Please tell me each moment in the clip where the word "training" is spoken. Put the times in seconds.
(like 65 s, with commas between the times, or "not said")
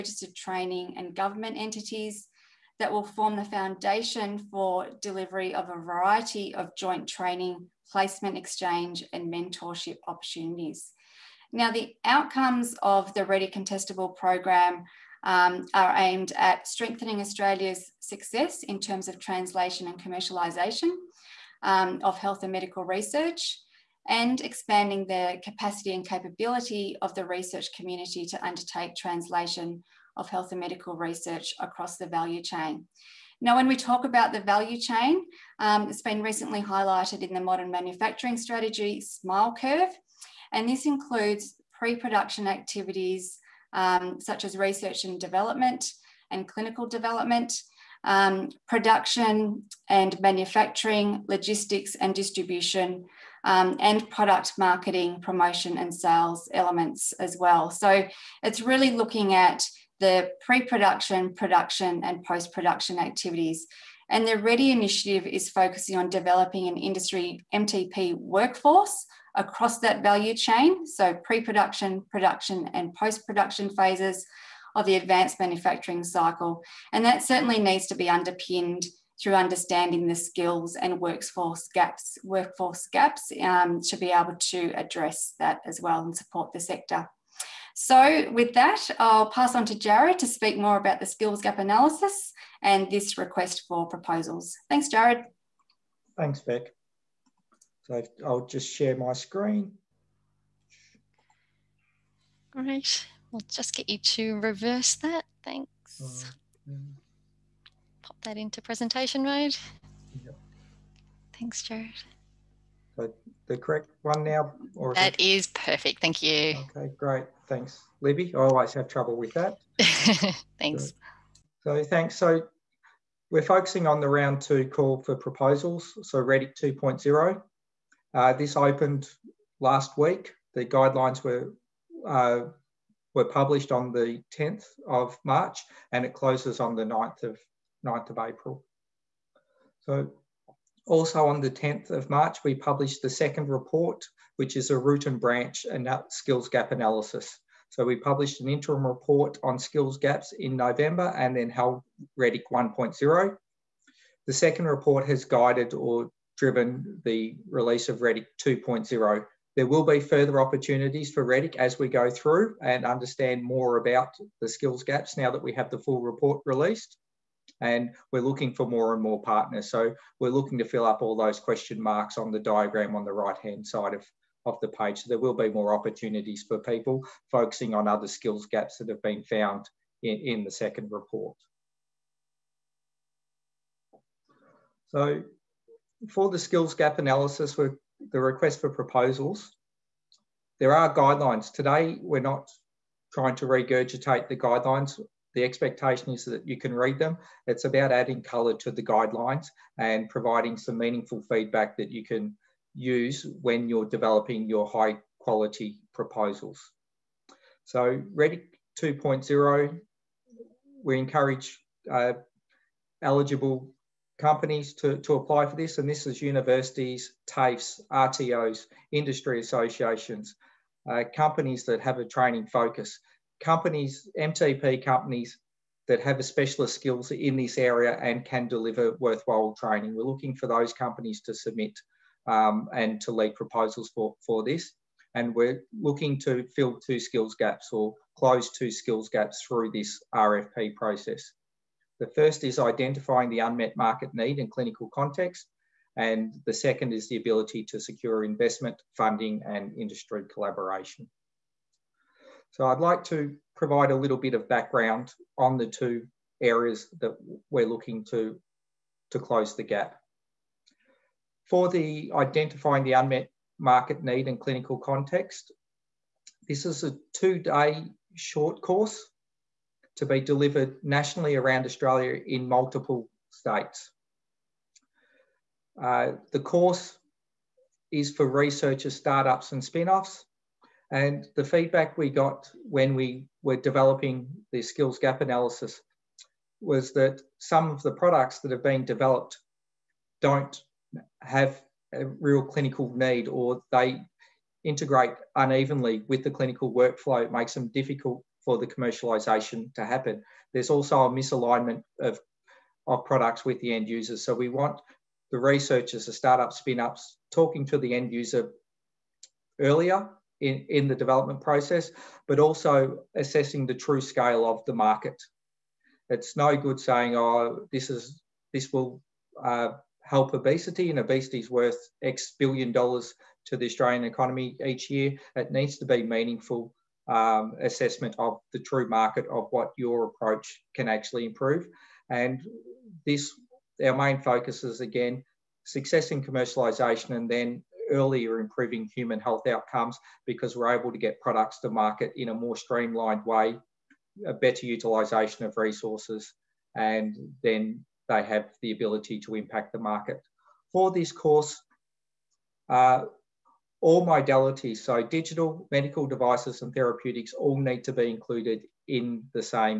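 0 s, 7 s, 222 s, 229 s.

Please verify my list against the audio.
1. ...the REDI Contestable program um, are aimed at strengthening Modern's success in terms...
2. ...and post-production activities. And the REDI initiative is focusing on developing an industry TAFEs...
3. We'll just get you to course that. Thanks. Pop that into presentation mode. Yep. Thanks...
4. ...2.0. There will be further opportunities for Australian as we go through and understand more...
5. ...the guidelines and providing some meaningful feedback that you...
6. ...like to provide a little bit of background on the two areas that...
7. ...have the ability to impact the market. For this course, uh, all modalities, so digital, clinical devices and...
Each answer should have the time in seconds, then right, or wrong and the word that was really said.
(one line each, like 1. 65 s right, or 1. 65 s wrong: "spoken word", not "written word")
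1. 13 s wrong: "Australia", not "Modern"
2. 62 s wrong: "MTP", not "TAFEs"
3. 103 s wrong: "reverse", not "course"
4. 158 s wrong: "Redic", not "Australian"
5. 198 s right
6. 252 s right
7. 348 s wrong: "medical", not "clinical".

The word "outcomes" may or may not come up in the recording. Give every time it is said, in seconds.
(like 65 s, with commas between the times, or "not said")
12 s, 339 s.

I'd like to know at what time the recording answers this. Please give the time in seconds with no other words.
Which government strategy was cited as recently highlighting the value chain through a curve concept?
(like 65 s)
37 s.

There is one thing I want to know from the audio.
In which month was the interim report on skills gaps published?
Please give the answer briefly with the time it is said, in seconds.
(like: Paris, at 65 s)
November, at 150 s.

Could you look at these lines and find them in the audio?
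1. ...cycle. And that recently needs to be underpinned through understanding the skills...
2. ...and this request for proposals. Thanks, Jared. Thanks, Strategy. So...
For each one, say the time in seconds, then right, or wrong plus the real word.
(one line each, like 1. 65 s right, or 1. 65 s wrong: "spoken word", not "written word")
1. 76 s wrong: "certainly", not "recently"
2. 92 s wrong: "Beck", not "Strategy".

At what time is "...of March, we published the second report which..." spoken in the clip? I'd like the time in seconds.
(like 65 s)
141 s.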